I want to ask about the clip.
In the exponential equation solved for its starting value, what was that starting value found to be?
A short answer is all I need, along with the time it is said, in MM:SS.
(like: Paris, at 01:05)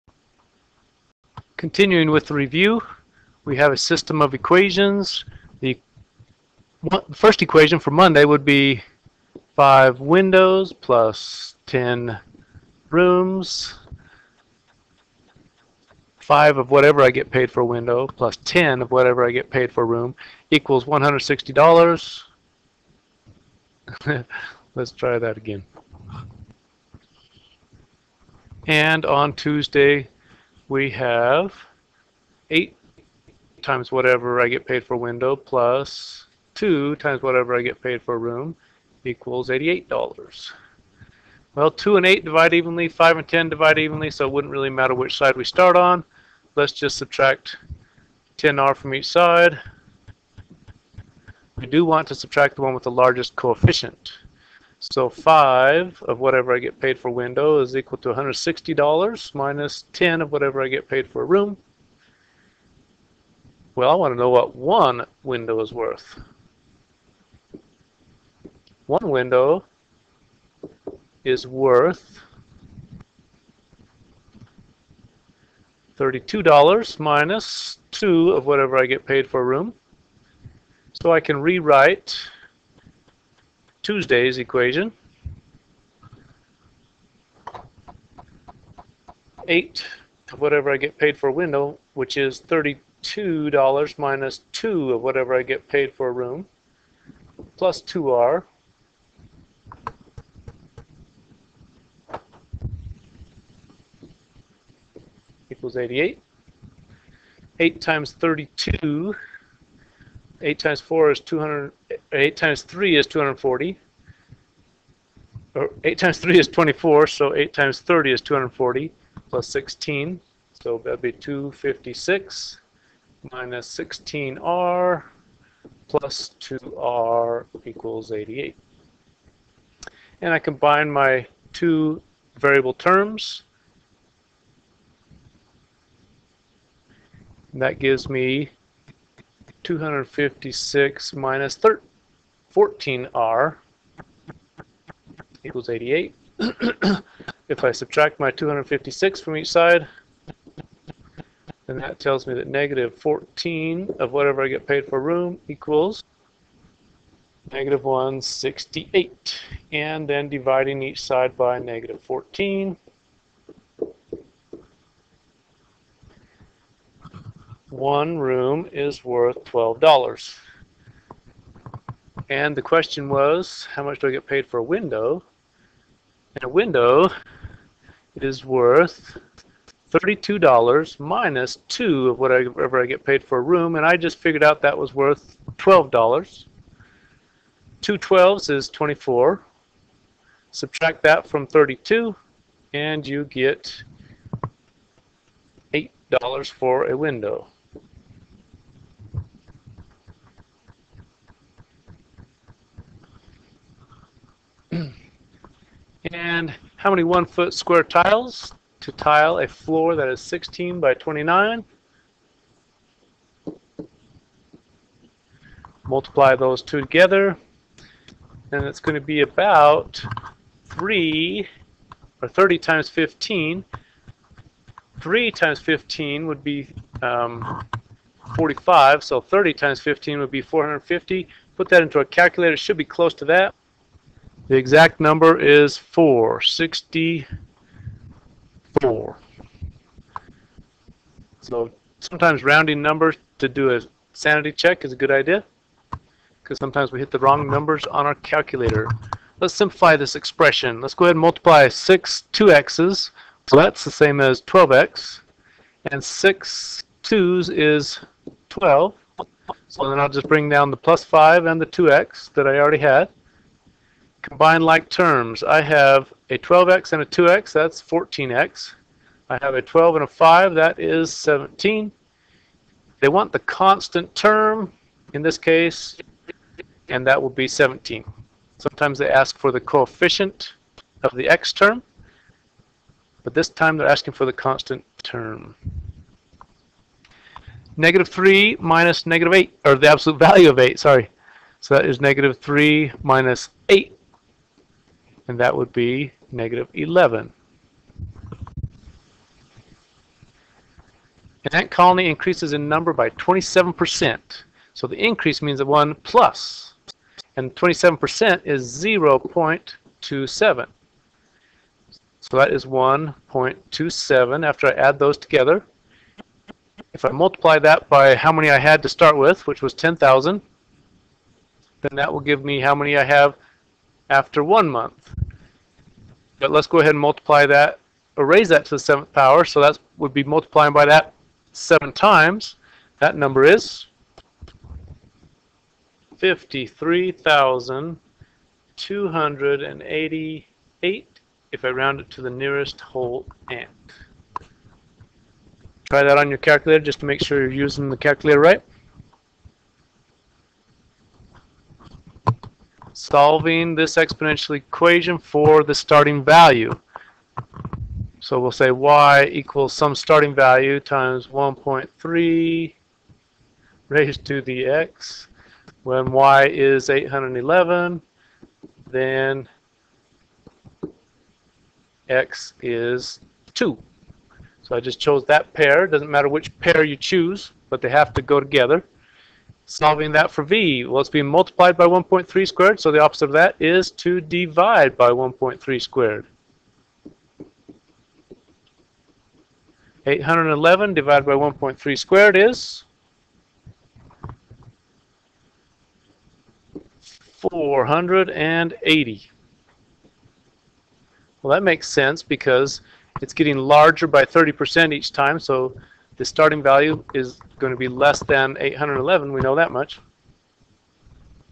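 480, at 06:37.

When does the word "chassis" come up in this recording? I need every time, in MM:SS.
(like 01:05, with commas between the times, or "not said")
not said.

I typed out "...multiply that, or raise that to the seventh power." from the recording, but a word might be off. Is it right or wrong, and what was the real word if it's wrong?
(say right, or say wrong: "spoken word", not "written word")
right.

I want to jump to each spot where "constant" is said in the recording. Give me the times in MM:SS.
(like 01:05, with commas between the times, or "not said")
04:33, 04:44.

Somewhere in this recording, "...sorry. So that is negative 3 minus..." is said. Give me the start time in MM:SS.
04:50.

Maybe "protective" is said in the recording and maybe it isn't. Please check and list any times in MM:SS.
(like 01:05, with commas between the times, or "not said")
not said.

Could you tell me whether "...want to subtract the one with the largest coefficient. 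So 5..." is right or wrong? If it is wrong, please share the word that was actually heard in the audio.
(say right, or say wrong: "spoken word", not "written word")
right.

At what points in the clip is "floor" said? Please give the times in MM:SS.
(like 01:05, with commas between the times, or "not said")
03:29.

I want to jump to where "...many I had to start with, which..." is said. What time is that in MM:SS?
05:18.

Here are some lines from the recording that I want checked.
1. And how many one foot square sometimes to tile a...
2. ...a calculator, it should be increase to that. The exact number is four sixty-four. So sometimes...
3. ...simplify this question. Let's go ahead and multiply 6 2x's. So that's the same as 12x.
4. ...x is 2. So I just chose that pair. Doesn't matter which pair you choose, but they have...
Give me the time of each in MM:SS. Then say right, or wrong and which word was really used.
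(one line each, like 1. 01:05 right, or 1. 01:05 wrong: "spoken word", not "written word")
1. 03:26 wrong: "tiles", not "sometimes"
2. 03:51 wrong: "close", not "increase"
3. 04:09 wrong: "expression", not "question"
4. 06:12 right.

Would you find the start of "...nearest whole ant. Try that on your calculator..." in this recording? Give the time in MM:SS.
05:42.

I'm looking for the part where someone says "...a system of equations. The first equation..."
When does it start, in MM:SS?
00:03.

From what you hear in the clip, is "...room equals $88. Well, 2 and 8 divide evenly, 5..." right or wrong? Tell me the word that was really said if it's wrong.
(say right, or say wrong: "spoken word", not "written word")
right.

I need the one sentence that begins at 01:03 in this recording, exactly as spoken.
Well, I want to know what one window is worth.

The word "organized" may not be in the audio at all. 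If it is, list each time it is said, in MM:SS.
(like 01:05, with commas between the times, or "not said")
not said.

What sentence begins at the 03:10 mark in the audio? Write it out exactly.
Subtract that from 32, and you get $8 for a window.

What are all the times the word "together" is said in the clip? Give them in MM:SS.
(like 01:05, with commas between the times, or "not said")
03:36, 05:15, 06:18.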